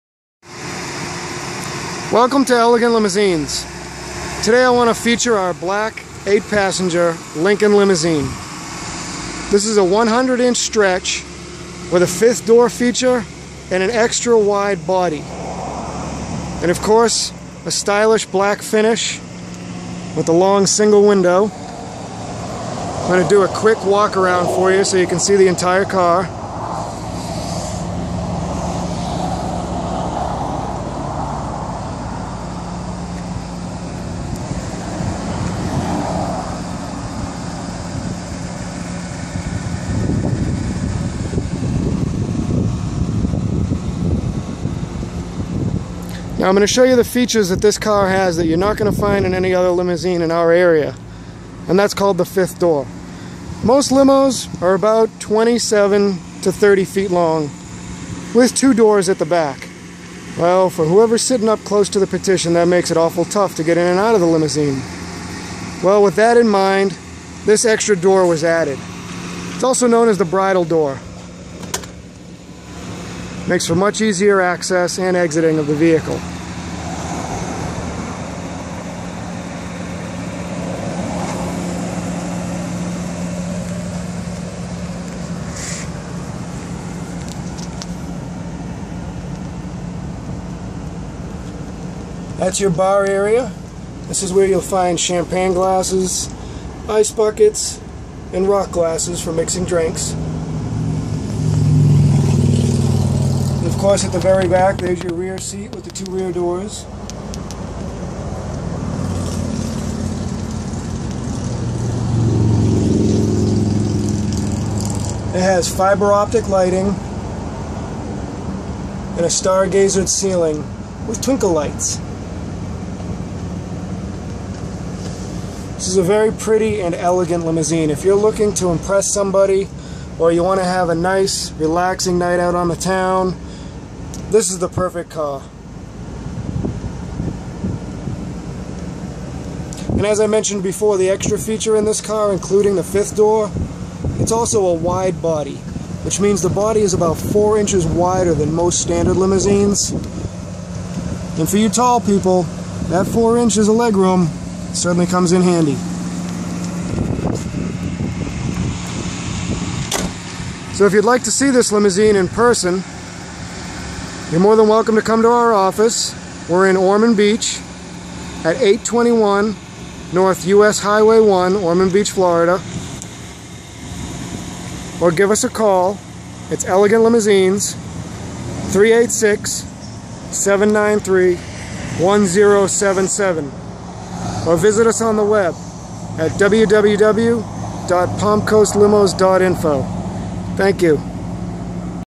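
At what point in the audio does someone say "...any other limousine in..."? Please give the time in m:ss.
0:49.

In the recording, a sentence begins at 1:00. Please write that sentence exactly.
Well, for whoever's sitting up close to the partition, that makes it awful tough to get in and out of the limousine.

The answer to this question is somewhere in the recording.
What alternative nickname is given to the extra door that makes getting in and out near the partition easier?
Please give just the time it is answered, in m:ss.
1:10.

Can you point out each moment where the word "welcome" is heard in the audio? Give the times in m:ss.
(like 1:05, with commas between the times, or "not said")
0:02, 2:44.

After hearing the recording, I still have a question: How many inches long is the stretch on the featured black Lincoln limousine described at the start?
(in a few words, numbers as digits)
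100.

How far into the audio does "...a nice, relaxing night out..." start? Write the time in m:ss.
2:10.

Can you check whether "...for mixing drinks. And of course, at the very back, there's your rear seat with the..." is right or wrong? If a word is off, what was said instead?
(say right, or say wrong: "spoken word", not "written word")
right.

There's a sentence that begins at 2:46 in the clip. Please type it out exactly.
We're in Ormond Beach at 821 North US Highway 1, Ormond Beach, Florida.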